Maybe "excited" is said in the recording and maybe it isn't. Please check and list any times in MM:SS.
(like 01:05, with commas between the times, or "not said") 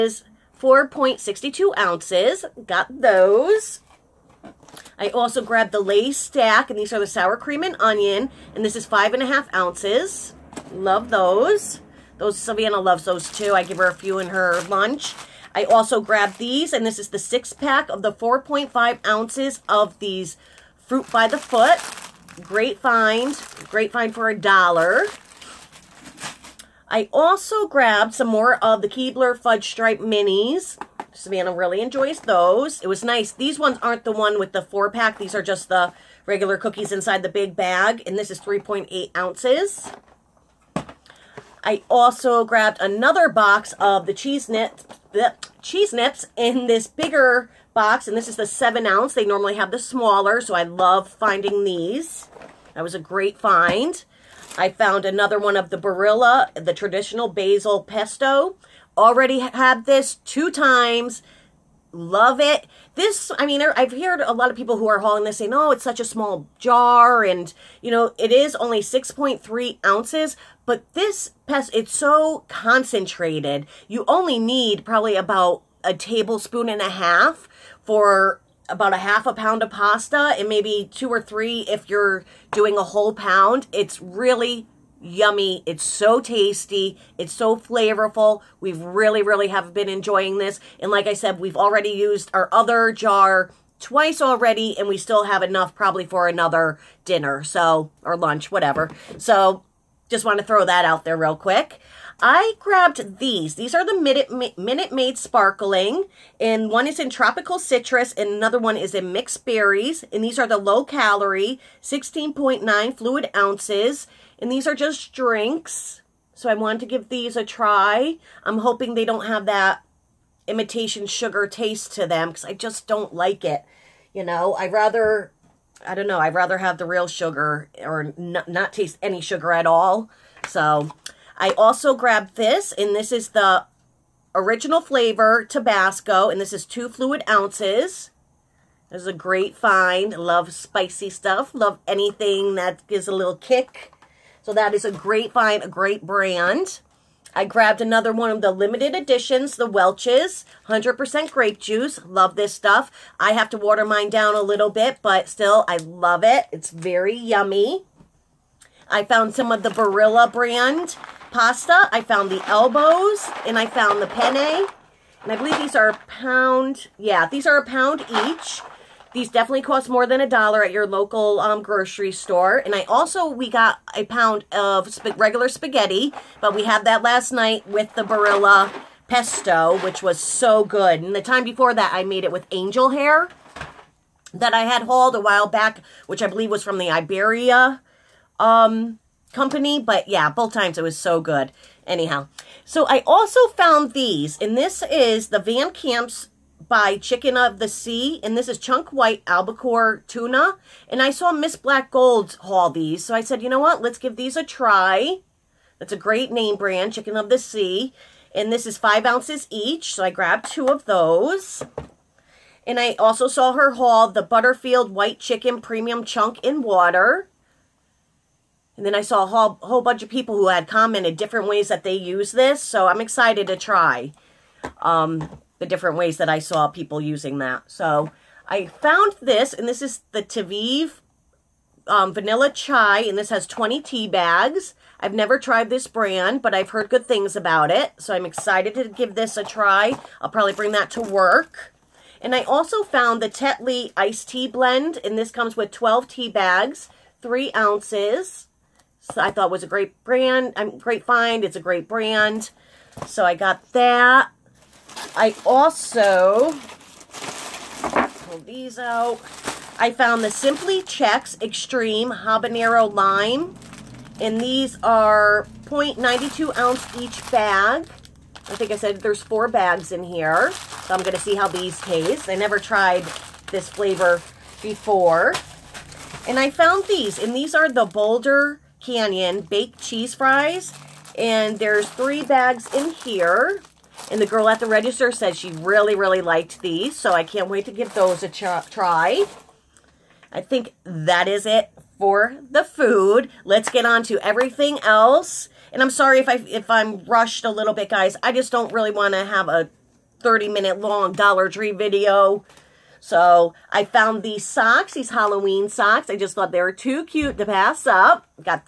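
03:42, 03:58.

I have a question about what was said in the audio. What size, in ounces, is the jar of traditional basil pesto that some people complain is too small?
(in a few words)
6.3 ounces.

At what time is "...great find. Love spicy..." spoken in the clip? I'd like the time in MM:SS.
02:19.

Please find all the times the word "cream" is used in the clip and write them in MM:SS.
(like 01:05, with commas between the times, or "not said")
00:07.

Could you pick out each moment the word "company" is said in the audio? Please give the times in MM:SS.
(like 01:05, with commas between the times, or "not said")
03:09.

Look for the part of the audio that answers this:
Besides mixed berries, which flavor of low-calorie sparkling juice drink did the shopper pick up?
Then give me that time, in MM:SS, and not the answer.
01:47.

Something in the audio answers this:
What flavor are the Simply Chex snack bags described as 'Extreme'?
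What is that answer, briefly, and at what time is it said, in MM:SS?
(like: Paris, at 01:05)
Habanero Lime, at 04:21.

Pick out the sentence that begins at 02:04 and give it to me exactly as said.
i rather, I don't know, I'd rather have the real sugar, or not taste any sugar at all, so...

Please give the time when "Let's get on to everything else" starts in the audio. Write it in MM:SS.
04:53.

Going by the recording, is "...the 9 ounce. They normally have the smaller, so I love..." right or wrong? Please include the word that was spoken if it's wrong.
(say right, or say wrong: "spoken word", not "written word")
wrong: "7", not "9".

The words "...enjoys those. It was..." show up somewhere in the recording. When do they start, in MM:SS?
00:31.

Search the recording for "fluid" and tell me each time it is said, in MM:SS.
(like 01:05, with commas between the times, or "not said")
01:52, 02:16.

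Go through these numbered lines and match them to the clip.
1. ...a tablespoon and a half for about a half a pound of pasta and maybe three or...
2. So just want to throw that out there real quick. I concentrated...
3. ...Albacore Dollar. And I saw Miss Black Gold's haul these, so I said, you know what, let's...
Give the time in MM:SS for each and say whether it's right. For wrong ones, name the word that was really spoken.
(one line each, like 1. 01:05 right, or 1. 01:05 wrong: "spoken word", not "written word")
1. 01:15 wrong: "two", not "three"
2. 01:39 wrong: "grabbed", not "concentrated"
3. 03:19 wrong: "Tuna", not "Dollar".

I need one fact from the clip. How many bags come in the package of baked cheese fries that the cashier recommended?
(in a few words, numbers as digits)
3.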